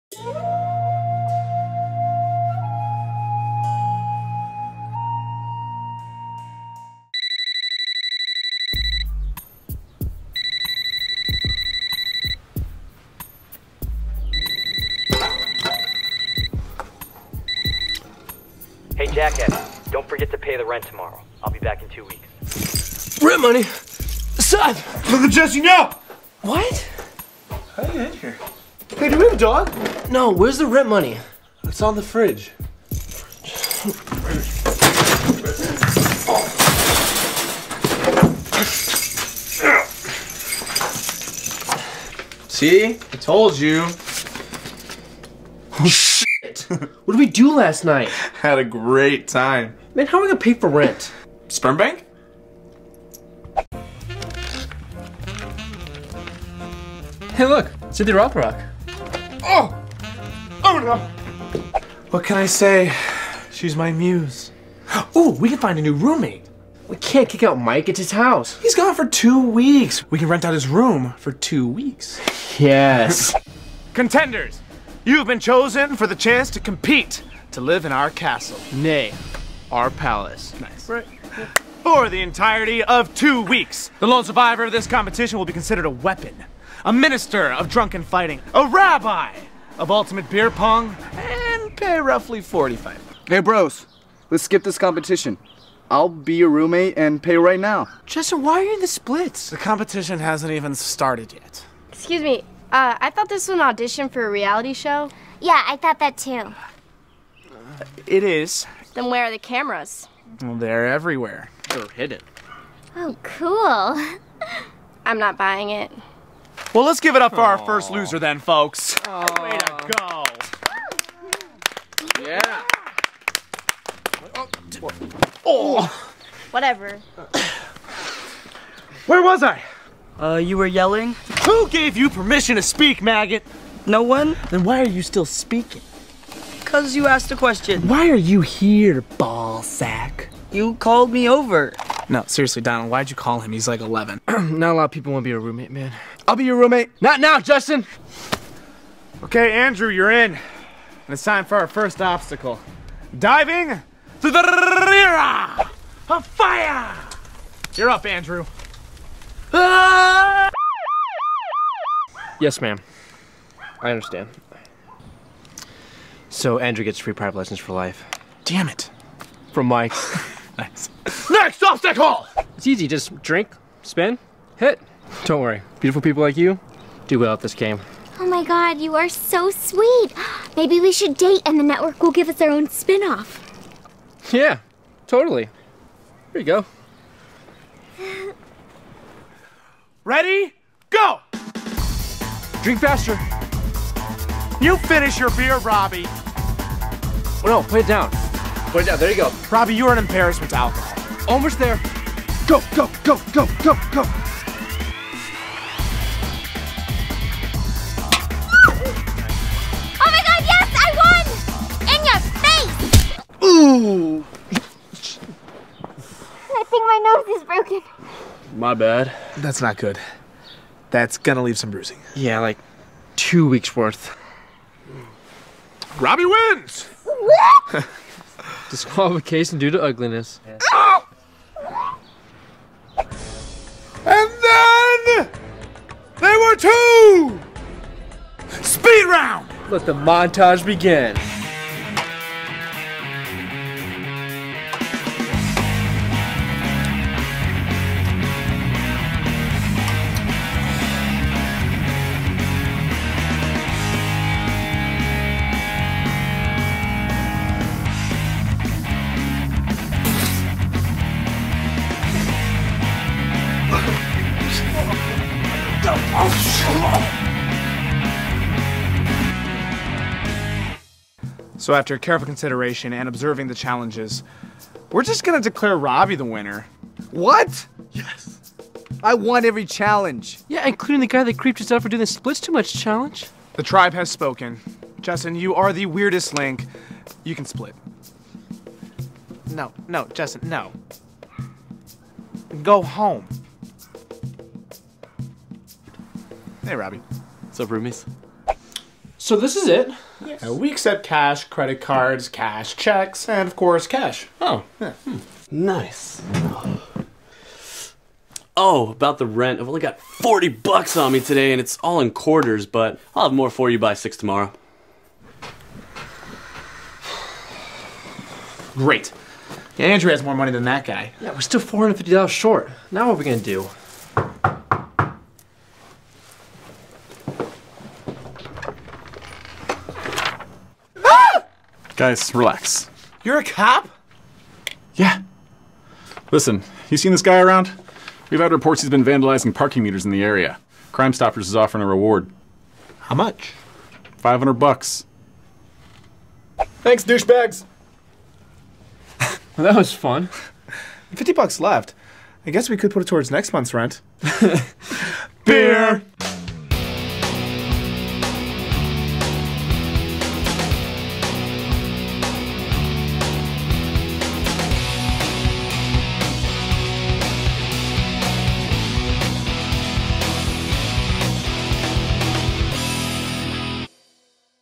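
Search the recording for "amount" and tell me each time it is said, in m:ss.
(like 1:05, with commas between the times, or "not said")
not said.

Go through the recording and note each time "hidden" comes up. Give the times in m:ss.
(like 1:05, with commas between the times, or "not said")
1:51.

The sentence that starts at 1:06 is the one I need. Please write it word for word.
We can't kick out Mike, it's his house.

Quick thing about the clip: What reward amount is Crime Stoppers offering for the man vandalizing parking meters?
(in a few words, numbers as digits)
500 bucks.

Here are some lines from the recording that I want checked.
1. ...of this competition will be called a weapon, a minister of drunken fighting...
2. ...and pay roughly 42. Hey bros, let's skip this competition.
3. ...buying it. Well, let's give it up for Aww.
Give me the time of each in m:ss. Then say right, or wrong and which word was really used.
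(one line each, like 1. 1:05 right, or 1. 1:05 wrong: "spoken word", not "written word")
1. 1:24 wrong: "considered", not "called"
2. 1:31 wrong: "45", not "42"
3. 1:55 right.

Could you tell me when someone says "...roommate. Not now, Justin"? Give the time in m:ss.
2:26.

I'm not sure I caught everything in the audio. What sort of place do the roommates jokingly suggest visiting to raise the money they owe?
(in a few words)
Sperm bank.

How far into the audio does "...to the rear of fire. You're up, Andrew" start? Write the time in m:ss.
2:34.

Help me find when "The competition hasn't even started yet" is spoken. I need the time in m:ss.
1:39.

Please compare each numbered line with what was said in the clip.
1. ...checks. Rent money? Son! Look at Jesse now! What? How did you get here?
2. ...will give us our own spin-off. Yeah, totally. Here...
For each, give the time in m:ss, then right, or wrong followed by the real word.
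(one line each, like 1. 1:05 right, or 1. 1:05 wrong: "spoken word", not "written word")
1. 0:22 wrong: "weeks", not "checks"
2. 3:02 right.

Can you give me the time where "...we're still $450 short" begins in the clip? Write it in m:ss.
5:21.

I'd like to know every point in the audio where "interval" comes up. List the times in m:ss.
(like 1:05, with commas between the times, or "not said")
not said.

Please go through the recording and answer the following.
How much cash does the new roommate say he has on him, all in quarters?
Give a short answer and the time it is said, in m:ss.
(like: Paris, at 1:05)
40 bucks, at 5:09.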